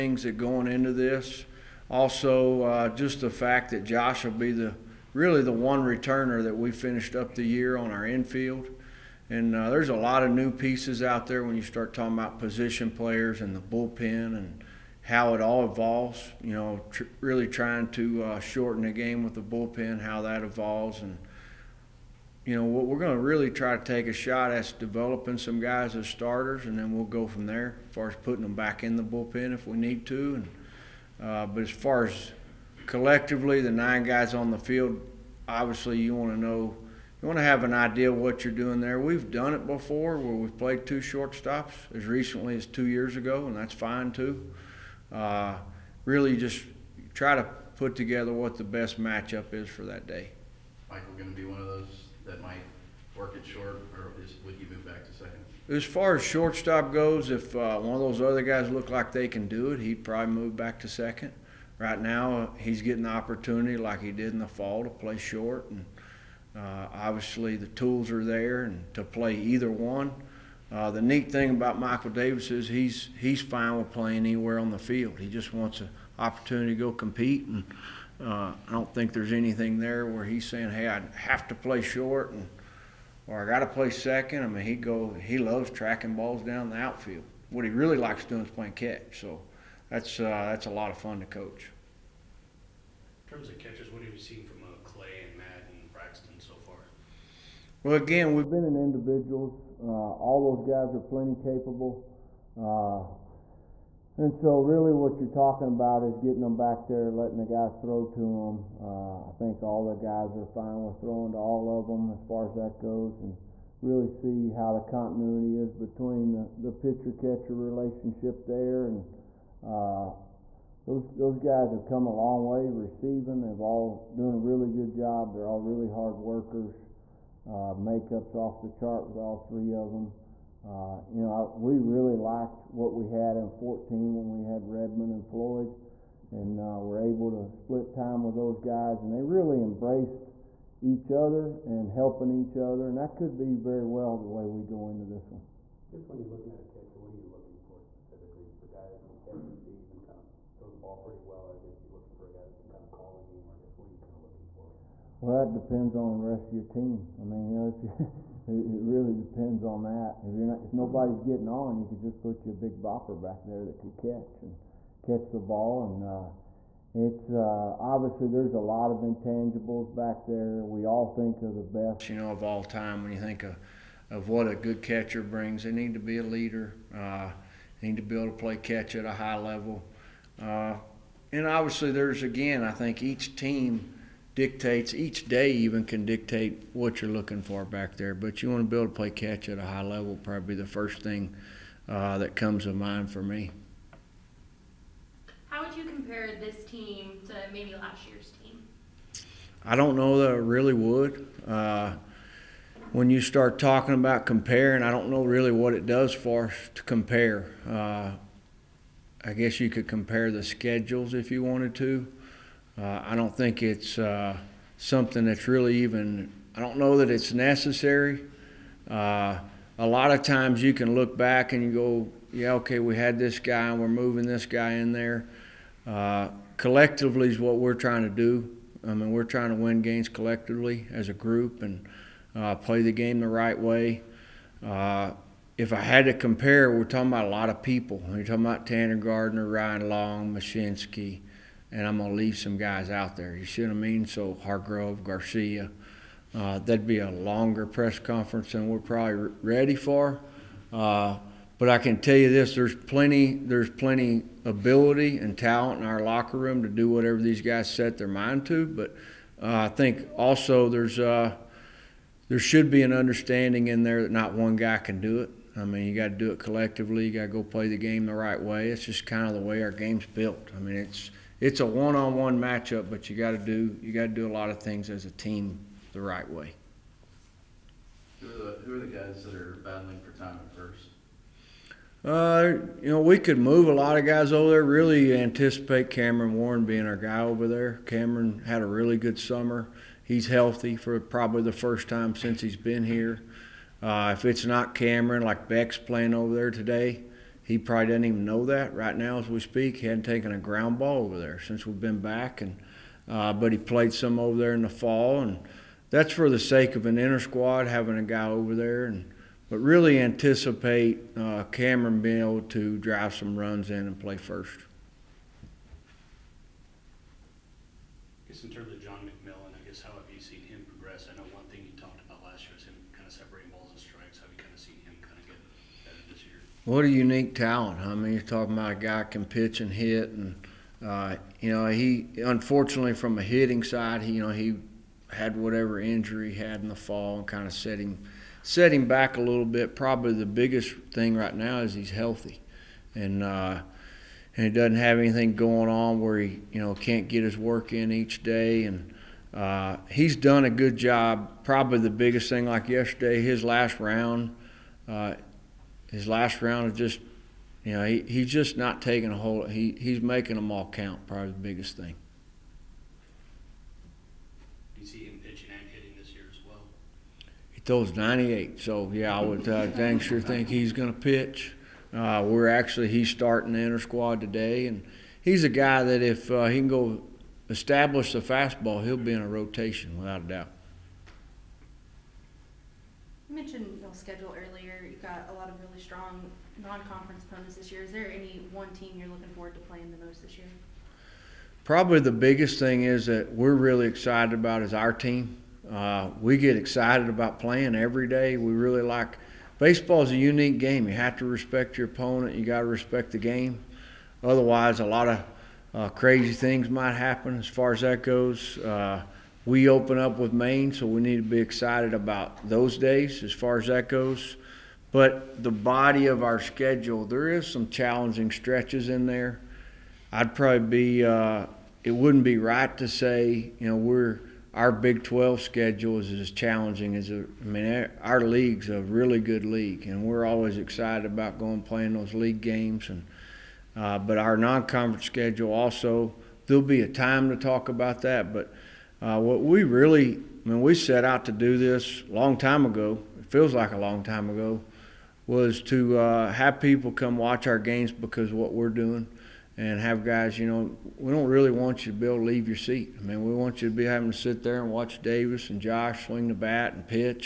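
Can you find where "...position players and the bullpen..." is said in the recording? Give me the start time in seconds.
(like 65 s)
12 s.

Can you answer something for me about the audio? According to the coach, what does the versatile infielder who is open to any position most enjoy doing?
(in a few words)
Playing catch.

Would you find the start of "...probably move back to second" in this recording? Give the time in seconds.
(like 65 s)
60 s.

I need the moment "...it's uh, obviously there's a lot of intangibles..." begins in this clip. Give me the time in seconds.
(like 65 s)
166 s.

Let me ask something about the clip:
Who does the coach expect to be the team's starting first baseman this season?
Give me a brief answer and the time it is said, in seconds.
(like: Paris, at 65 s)
Cameron Warren, at 285 s.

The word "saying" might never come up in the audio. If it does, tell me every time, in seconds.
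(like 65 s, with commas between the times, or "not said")
80 s.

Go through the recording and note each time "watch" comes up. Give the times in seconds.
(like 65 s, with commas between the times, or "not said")
447 s, 454 s.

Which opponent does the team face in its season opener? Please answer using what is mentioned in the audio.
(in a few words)
Maine.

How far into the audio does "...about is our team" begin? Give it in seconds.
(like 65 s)
394 s.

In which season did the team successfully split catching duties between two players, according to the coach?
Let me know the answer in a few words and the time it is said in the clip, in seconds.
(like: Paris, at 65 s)
2014, at 133 s.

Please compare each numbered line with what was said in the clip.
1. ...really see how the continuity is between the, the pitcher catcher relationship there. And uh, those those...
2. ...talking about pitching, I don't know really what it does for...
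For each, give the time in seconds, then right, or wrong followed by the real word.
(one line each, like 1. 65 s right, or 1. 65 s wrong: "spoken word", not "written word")
1. 113 s right
2. 203 s wrong: "comparing", not "pitching".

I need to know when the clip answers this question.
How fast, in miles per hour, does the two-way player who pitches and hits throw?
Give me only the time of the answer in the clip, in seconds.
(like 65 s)
367 s.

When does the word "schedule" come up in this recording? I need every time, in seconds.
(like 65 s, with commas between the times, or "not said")
210 s, 383 s, 416 s, 425 s, 435 s.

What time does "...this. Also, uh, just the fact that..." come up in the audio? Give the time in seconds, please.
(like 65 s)
0 s.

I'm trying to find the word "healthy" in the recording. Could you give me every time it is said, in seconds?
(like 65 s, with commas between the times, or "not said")
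290 s, 341 s.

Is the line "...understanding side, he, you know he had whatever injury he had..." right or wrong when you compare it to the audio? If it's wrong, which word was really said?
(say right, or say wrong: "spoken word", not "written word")
wrong: "hitting", not "understanding".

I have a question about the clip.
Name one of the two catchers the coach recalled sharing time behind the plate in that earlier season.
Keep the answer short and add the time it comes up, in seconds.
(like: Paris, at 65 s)
Redman, at 134 s.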